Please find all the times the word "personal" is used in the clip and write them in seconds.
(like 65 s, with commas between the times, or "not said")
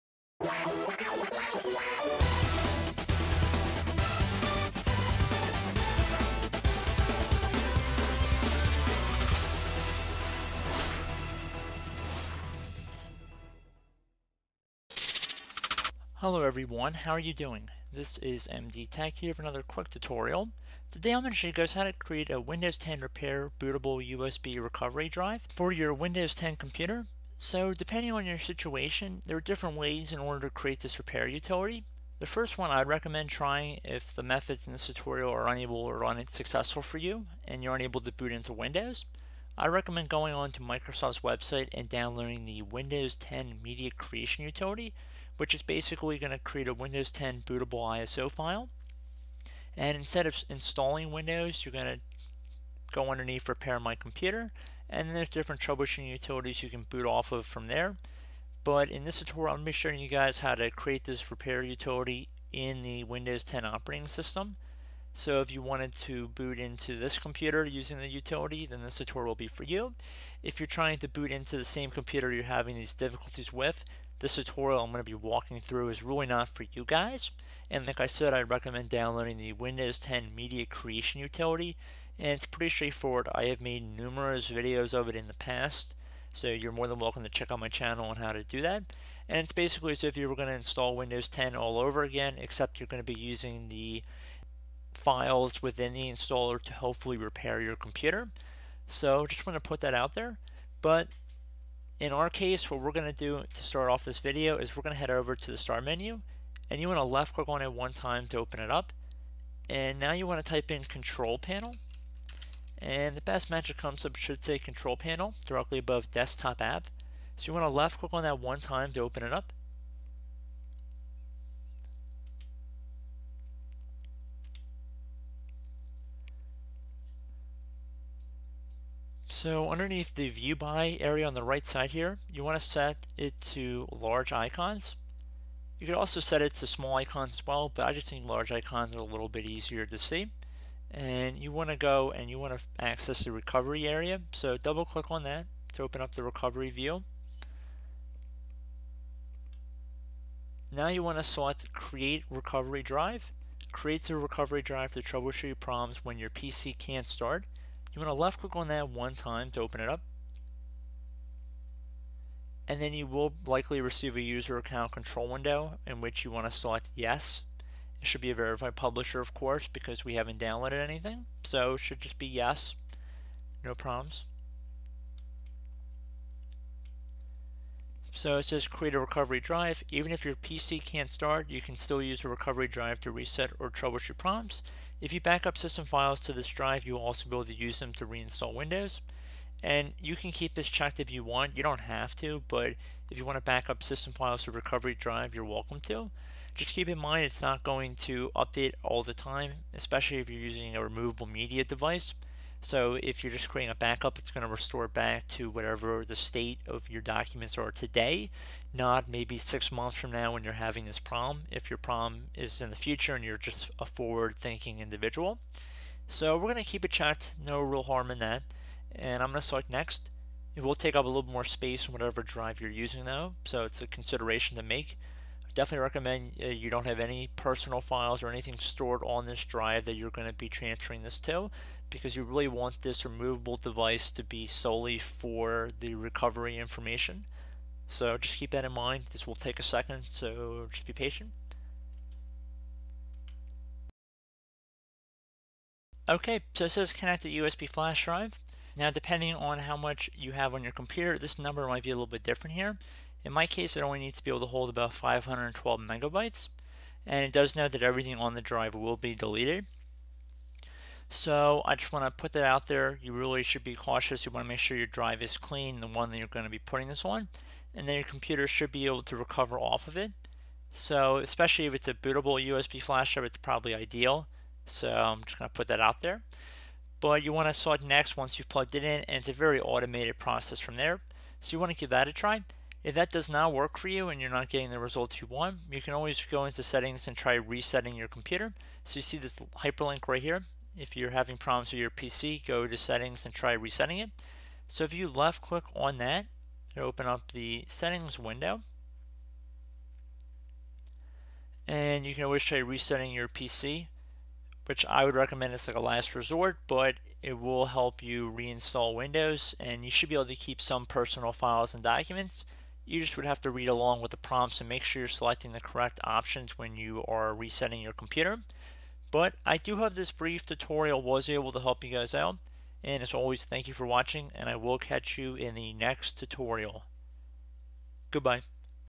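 227 s, 310 s.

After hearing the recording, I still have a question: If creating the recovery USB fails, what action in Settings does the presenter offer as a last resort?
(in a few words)
Resetting your PC.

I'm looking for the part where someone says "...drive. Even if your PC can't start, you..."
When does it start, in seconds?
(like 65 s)
179 s.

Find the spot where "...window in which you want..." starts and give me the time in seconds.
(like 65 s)
165 s.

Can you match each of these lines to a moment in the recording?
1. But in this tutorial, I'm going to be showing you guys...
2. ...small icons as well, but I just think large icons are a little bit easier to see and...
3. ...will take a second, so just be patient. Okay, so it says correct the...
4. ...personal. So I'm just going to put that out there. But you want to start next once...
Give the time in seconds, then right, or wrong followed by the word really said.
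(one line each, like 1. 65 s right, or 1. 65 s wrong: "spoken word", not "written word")
1. 58 s right
2. 136 s right
3. 239 s wrong: "connect", not "correct"
4. 273 s wrong: "ideal", not "personal".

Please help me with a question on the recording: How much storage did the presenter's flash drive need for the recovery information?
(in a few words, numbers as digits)
512 megabytes.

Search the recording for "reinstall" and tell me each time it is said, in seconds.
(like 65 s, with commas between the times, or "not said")
188 s, 308 s.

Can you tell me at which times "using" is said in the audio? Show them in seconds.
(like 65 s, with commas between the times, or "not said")
67 s, 93 s, 200 s, 222 s.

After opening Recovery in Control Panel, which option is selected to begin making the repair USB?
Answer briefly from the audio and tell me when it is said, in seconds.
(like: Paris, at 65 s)
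Create recovery drive, at 151 s.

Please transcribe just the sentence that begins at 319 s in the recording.
But I do have this brief tutorial was able to help you guys out.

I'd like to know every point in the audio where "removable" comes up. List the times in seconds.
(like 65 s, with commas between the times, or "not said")
200 s, 233 s.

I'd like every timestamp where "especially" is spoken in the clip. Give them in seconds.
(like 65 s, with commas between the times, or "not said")
199 s, 271 s.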